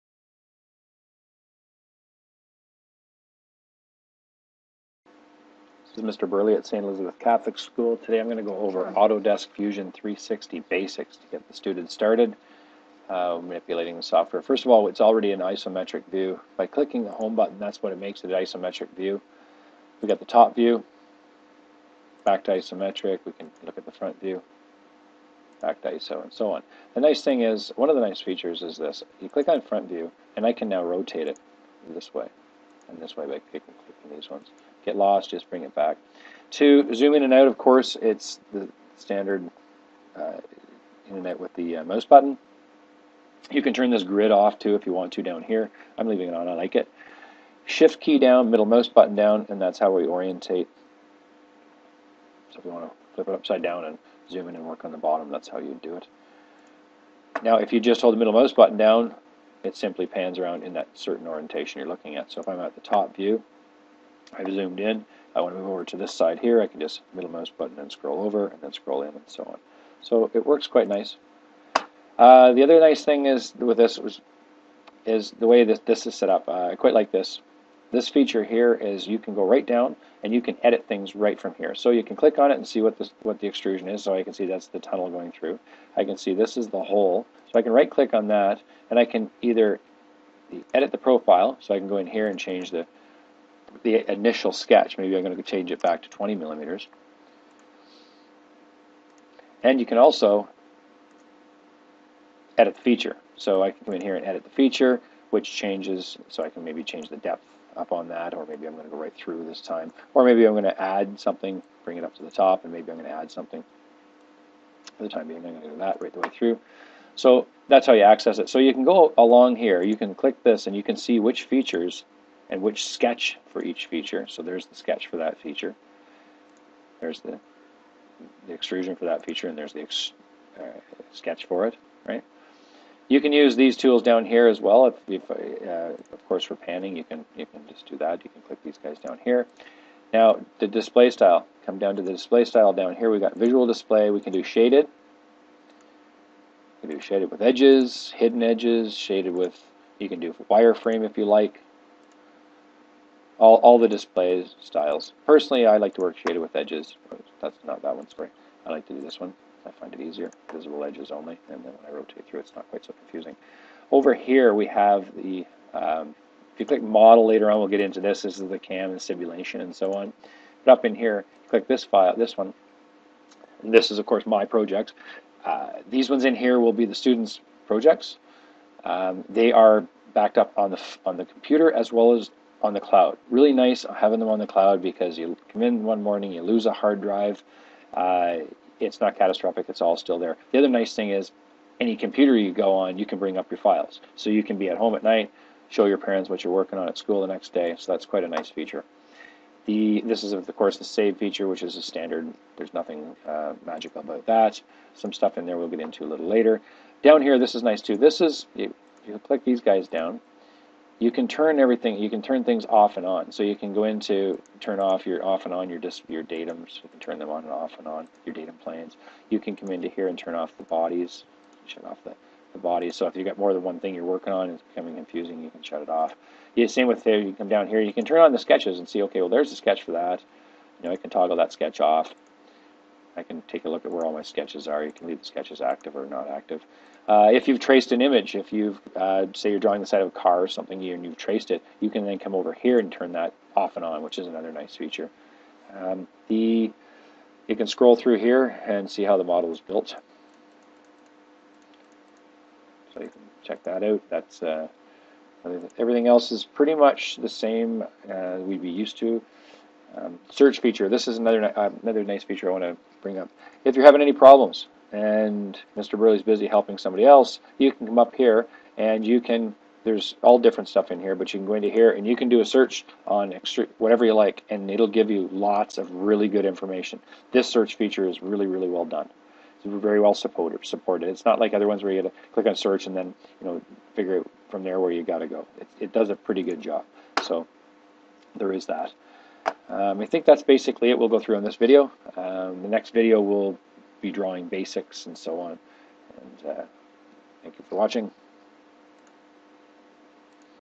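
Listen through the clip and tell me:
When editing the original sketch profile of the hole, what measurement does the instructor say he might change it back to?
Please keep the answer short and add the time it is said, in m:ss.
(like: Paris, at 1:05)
20 millimeters, at 1:36.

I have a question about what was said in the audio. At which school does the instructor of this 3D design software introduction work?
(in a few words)
St. Elizabeth Catholic School.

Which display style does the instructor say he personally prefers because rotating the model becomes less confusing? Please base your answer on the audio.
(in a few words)
Visible edges only.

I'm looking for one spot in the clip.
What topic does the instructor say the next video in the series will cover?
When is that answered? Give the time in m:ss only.
4:54.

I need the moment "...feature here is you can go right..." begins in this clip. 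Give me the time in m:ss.
1:18.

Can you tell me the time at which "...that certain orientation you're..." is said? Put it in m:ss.
1:00.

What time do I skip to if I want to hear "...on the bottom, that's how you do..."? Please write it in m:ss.
0:54.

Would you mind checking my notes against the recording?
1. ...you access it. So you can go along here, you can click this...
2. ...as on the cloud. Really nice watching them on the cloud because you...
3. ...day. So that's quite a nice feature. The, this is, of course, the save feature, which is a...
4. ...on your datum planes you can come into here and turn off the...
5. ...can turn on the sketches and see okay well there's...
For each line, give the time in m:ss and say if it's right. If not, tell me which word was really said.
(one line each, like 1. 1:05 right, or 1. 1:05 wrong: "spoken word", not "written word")
1. 1:57 right
2. 3:02 wrong: "having", not "watching"
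3. 3:17 right
4. 3:37 right
5. 3:47 right.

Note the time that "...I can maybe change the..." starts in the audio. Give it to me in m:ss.
1:46.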